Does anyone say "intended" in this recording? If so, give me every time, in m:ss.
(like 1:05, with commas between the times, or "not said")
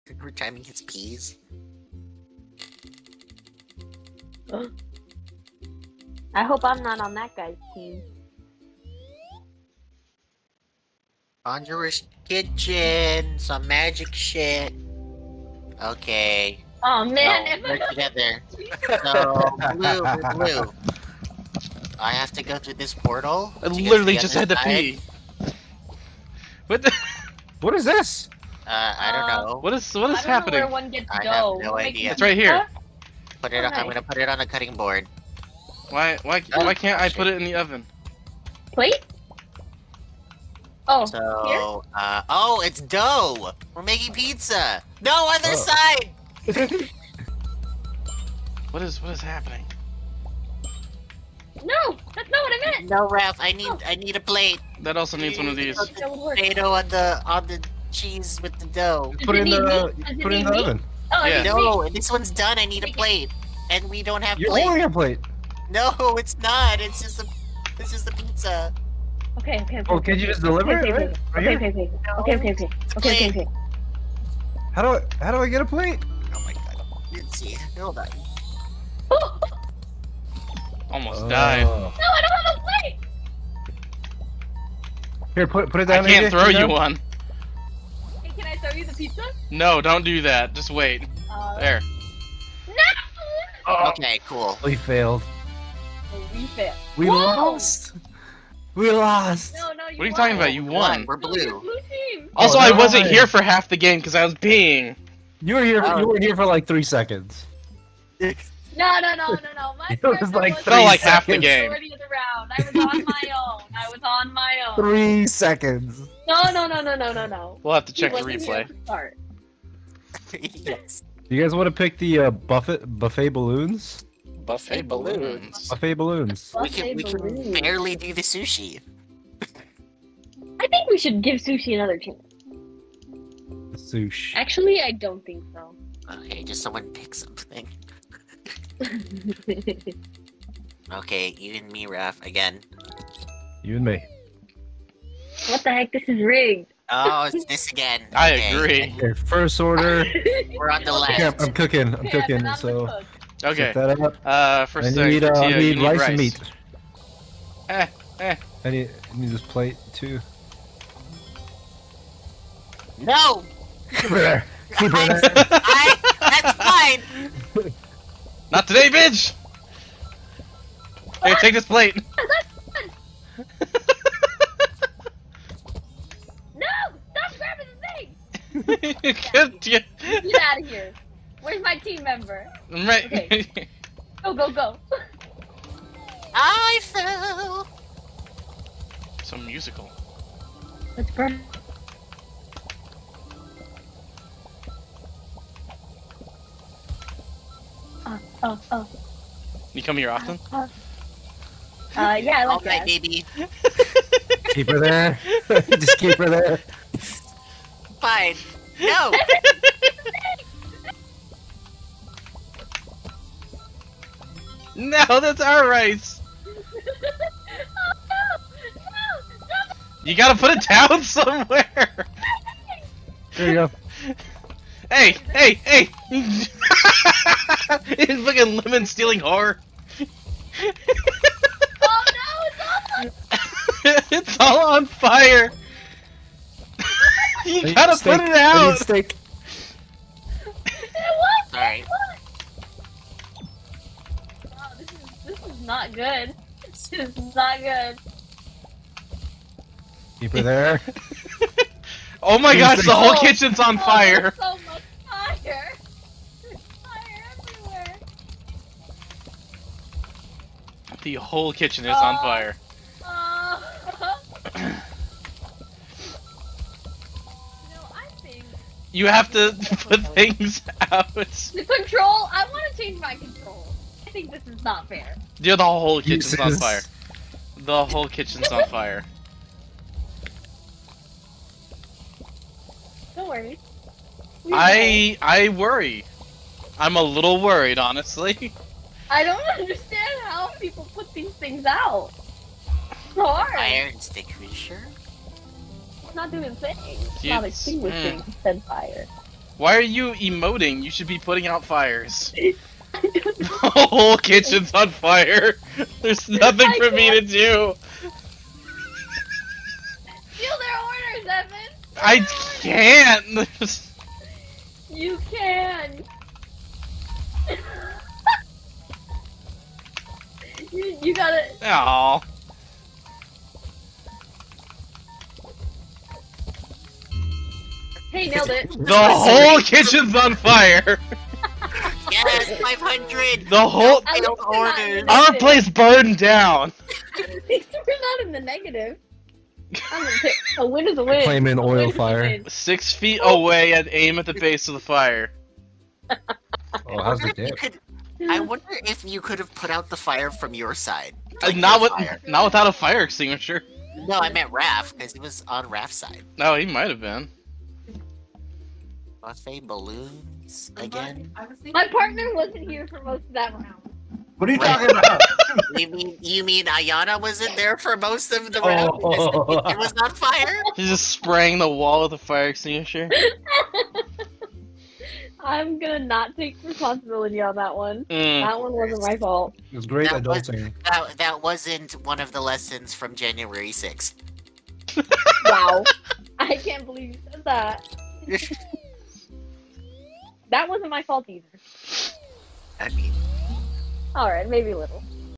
not said.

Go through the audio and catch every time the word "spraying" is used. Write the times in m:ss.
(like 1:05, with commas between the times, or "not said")
6:11.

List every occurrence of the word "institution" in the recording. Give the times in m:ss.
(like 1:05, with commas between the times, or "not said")
not said.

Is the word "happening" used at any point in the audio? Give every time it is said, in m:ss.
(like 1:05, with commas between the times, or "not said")
0:30, 0:49.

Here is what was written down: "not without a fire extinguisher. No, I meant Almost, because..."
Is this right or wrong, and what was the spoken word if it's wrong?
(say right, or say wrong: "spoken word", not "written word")
wrong: "Raph", not "Almost".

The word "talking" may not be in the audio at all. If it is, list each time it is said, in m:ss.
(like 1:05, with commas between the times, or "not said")
1:40, 6:04.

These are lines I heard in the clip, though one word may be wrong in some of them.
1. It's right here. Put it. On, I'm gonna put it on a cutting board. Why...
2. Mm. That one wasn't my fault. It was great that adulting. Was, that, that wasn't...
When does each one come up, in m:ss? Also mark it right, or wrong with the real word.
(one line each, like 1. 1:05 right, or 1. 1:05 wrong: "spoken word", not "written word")
1. 0:32 right
2. 6:18 right.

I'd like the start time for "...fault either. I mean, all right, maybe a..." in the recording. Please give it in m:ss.
6:31.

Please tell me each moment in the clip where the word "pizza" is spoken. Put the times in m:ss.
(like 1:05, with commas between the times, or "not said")
0:44, 1:08, 1:28.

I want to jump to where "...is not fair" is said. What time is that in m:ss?
4:34.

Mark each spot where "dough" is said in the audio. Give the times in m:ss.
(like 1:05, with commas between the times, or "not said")
0:42, 0:58.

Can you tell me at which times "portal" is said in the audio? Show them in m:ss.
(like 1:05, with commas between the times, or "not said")
0:22.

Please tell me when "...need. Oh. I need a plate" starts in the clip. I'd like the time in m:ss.
0:53.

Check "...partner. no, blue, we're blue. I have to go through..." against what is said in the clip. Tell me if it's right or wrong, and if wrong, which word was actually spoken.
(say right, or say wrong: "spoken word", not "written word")
wrong: "together", not "partner".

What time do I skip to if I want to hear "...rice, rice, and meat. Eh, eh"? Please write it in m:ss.
2:35.